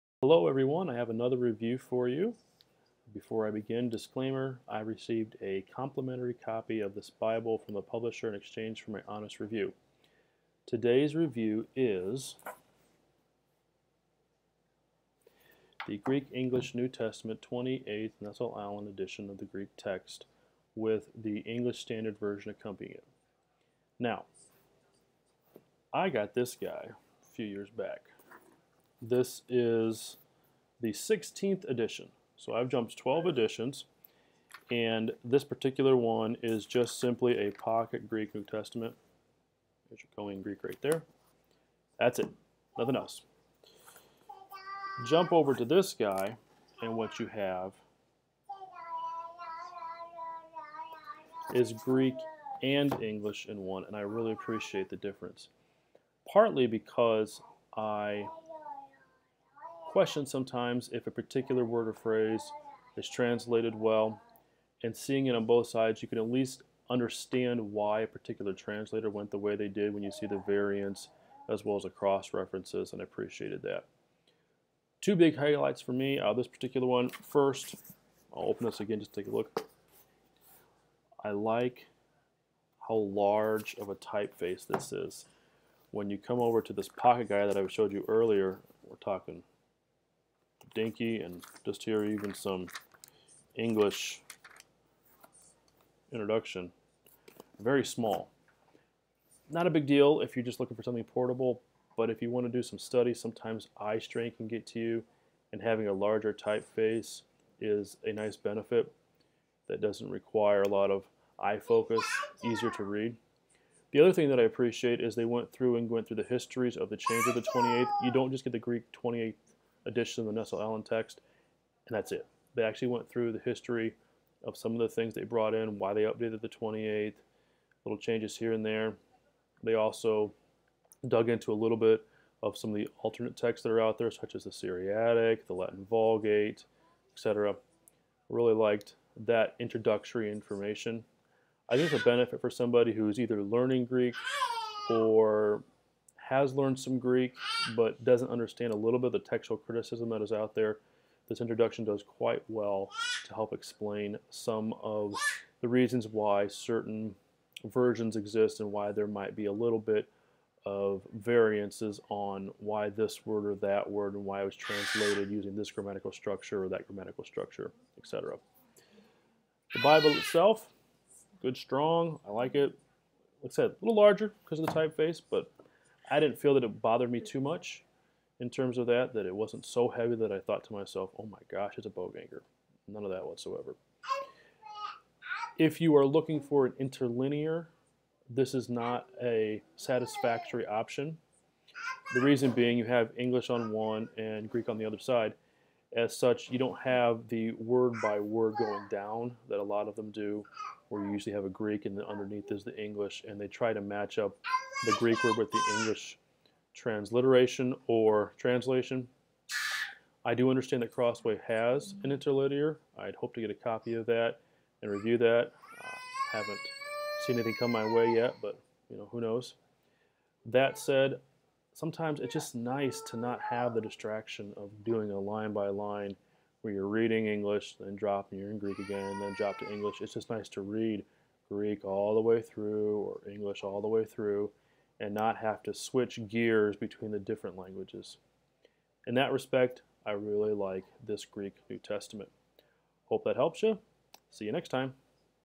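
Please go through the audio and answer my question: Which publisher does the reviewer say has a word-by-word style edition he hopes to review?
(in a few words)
Crossway.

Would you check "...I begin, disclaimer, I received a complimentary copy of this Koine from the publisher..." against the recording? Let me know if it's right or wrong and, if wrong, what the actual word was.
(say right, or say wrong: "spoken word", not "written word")
wrong: "Bible", not "Koine".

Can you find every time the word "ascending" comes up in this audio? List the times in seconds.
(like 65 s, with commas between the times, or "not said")
not said.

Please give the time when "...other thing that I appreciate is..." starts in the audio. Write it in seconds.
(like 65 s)
113 s.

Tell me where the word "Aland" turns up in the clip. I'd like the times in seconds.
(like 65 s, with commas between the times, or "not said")
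18 s, 120 s.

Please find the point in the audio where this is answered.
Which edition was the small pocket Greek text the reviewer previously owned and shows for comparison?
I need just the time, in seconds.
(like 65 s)
30 s.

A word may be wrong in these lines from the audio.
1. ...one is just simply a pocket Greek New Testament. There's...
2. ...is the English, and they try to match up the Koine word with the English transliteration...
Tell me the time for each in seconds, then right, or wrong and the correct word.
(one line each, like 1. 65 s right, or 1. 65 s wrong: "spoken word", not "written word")
1. 35 s right
2. 202 s wrong: "Greek", not "Koine".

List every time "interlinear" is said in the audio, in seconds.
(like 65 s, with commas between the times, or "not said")
186 s, 212 s.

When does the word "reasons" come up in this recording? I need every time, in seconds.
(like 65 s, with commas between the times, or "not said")
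155 s, 192 s.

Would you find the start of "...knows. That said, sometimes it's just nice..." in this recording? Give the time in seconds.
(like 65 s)
219 s.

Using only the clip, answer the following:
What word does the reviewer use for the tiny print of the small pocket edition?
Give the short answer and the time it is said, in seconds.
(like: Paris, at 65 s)
Dinky, at 90 s.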